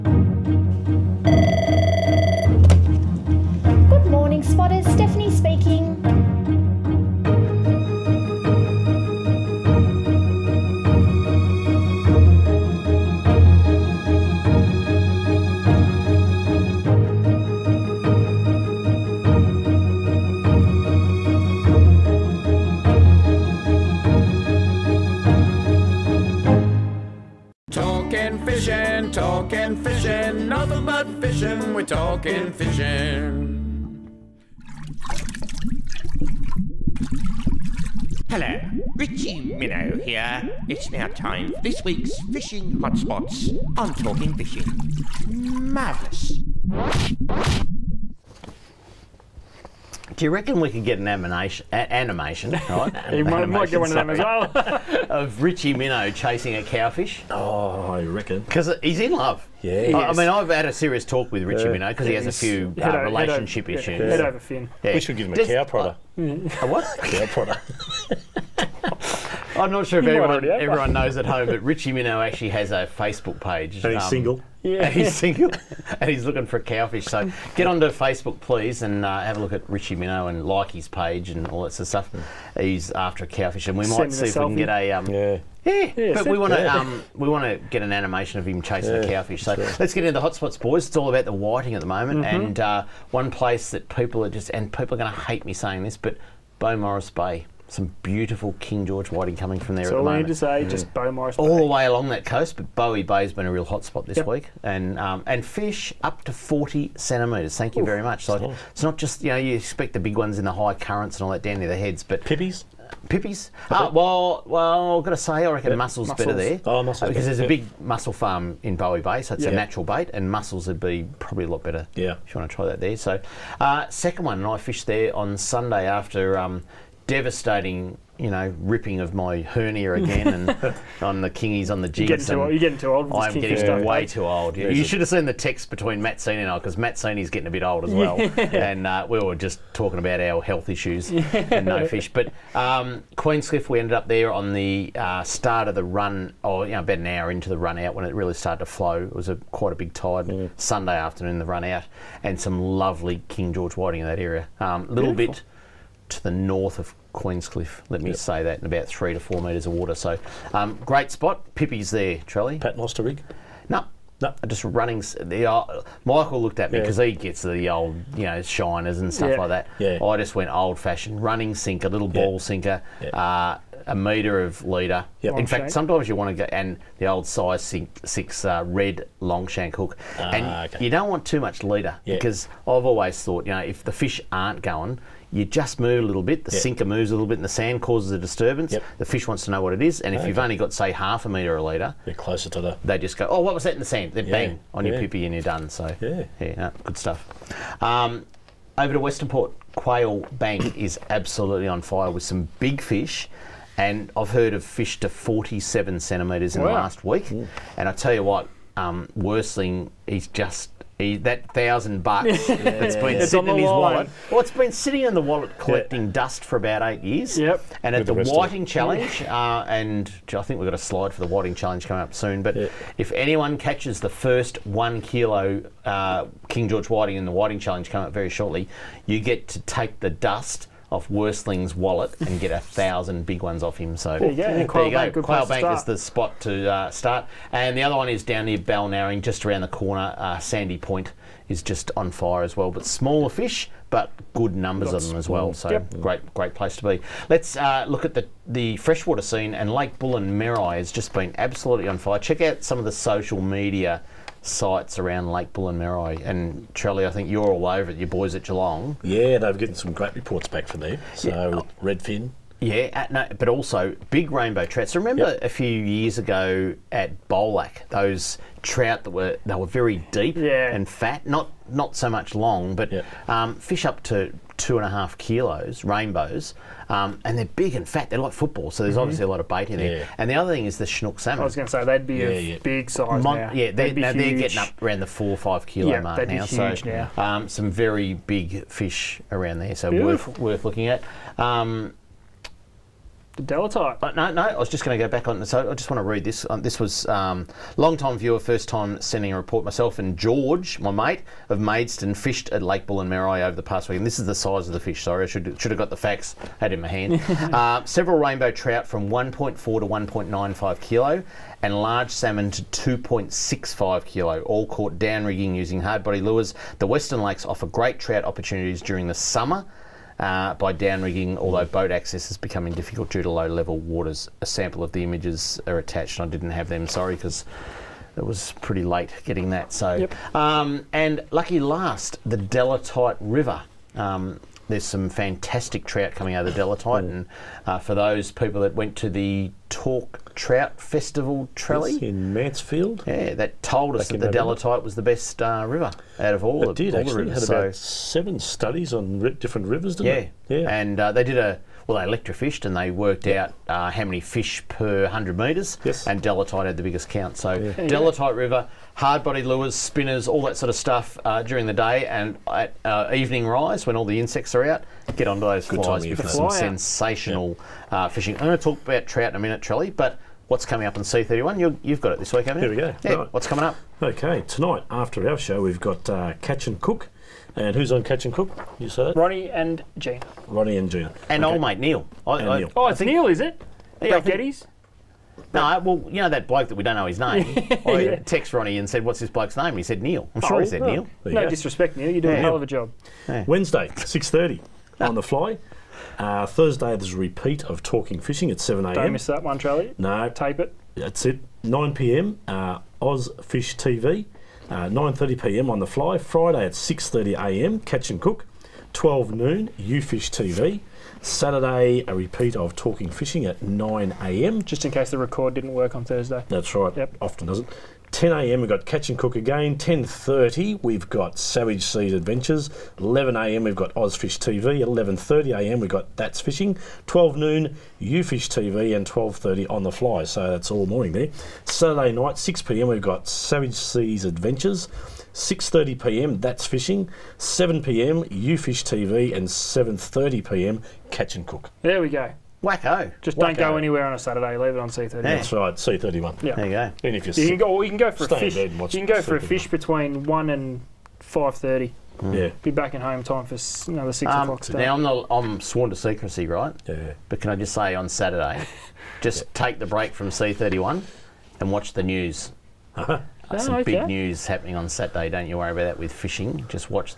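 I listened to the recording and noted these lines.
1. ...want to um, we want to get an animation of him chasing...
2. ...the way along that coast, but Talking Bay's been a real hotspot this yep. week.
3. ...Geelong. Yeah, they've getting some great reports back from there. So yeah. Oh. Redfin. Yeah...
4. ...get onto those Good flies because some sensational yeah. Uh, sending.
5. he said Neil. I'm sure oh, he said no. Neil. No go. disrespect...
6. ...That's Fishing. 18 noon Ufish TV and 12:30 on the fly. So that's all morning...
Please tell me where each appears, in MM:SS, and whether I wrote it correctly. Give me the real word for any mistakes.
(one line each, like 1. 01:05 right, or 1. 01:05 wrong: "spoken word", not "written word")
1. 01:26 right
2. 01:41 wrong: "Bowie", not "Talking"
3. 04:18 right
4. 06:05 wrong: "fishing", not "sending"
5. 06:29 right
6. 07:06 wrong: "12", not "18".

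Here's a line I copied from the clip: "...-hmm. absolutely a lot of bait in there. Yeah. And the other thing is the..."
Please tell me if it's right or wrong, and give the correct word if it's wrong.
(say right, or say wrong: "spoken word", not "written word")
wrong: "obviously", not "absolutely".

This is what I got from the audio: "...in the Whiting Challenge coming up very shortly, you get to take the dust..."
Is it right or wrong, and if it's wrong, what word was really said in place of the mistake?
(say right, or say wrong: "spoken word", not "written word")
right.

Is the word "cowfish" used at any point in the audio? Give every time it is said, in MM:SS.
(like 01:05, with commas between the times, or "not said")
00:56, 01:16, 01:23, 01:29.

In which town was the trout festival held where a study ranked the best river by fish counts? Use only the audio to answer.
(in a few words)
Mansfield.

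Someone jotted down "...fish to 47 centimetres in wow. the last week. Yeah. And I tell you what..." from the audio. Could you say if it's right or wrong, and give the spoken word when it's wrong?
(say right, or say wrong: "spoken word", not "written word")
right.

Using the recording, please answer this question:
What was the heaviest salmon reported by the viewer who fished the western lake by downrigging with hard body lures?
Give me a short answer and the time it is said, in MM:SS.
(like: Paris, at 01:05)
2.65 kilo, at 05:12.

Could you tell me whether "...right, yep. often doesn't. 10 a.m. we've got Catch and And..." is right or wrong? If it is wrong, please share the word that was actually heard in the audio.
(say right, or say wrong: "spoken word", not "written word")
wrong: "Cook", not "And".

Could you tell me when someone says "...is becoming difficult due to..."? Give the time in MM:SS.
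05:22.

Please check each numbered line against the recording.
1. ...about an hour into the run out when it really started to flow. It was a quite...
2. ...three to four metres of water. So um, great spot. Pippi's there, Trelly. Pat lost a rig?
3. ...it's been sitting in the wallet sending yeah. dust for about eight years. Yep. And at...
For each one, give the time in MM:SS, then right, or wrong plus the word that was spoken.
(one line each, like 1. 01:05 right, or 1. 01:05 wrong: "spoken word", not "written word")
1. 02:26 right
2. 02:38 right
3. 03:34 wrong: "collecting", not "sending".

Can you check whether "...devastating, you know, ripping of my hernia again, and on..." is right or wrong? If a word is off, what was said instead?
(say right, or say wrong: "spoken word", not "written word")
right.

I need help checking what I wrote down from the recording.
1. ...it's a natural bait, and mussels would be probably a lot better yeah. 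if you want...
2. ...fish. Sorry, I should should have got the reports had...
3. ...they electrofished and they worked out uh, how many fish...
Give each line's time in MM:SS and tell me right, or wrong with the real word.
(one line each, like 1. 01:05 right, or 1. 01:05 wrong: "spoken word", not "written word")
1. 01:59 right
2. 05:04 wrong: "facts", not "reports"
3. 05:52 right.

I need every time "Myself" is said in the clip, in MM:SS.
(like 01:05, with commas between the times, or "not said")
04:59.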